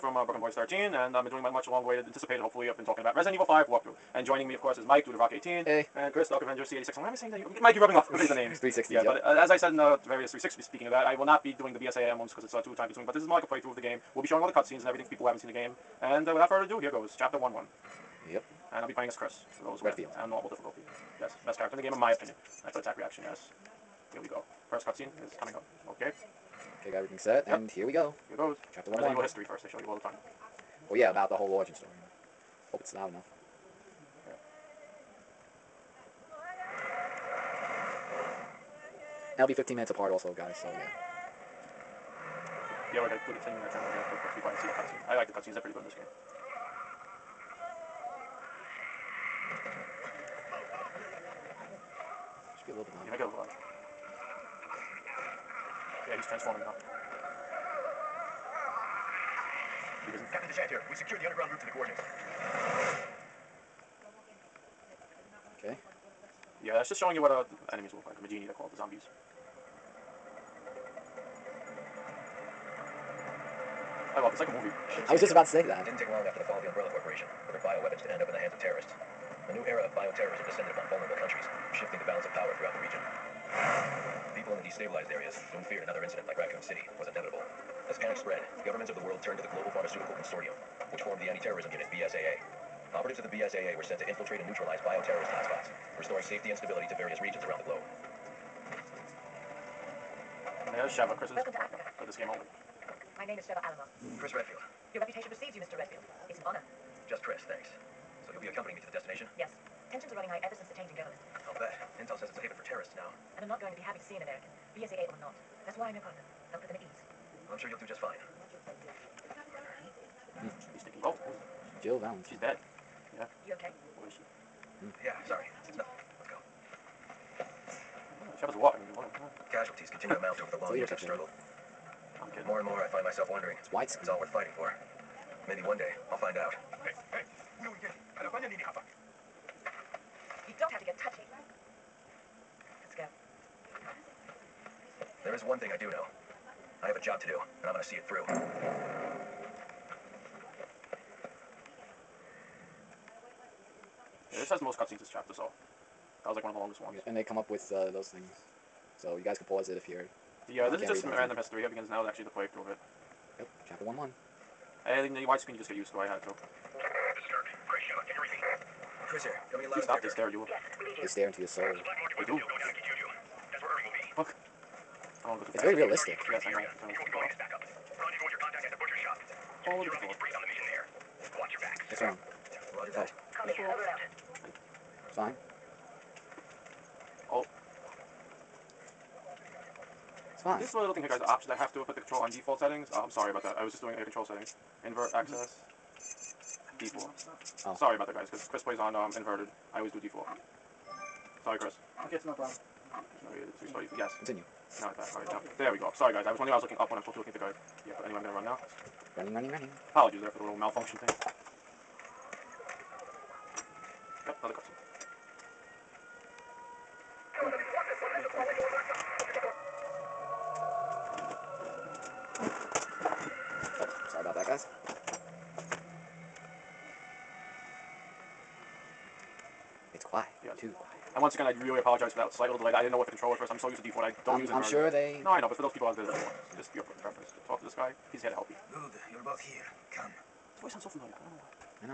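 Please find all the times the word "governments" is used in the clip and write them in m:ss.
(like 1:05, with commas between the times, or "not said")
1:28, 1:50.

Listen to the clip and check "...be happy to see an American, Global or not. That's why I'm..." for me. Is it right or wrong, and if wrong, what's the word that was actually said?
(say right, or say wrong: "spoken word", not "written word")
wrong: "BSAA", not "Global".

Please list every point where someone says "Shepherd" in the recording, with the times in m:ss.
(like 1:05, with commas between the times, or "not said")
2:08.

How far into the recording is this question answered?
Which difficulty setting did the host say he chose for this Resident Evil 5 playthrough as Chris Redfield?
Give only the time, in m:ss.
0:20.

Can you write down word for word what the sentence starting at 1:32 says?
Operatives of the BSAA were sent to infiltrate and neutralize bioterrorist hotspots, restoring safety and stability to various regions around the globe.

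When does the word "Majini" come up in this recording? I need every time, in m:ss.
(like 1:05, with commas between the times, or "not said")
1:08.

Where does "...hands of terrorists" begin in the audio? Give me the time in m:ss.
1:18.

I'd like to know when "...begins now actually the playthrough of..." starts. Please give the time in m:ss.
2:41.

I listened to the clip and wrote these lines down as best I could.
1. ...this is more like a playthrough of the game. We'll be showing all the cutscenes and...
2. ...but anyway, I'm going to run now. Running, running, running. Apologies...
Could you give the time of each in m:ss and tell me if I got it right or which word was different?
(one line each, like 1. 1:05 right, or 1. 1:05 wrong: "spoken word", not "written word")
1. 0:13 right
2. 3:27 right.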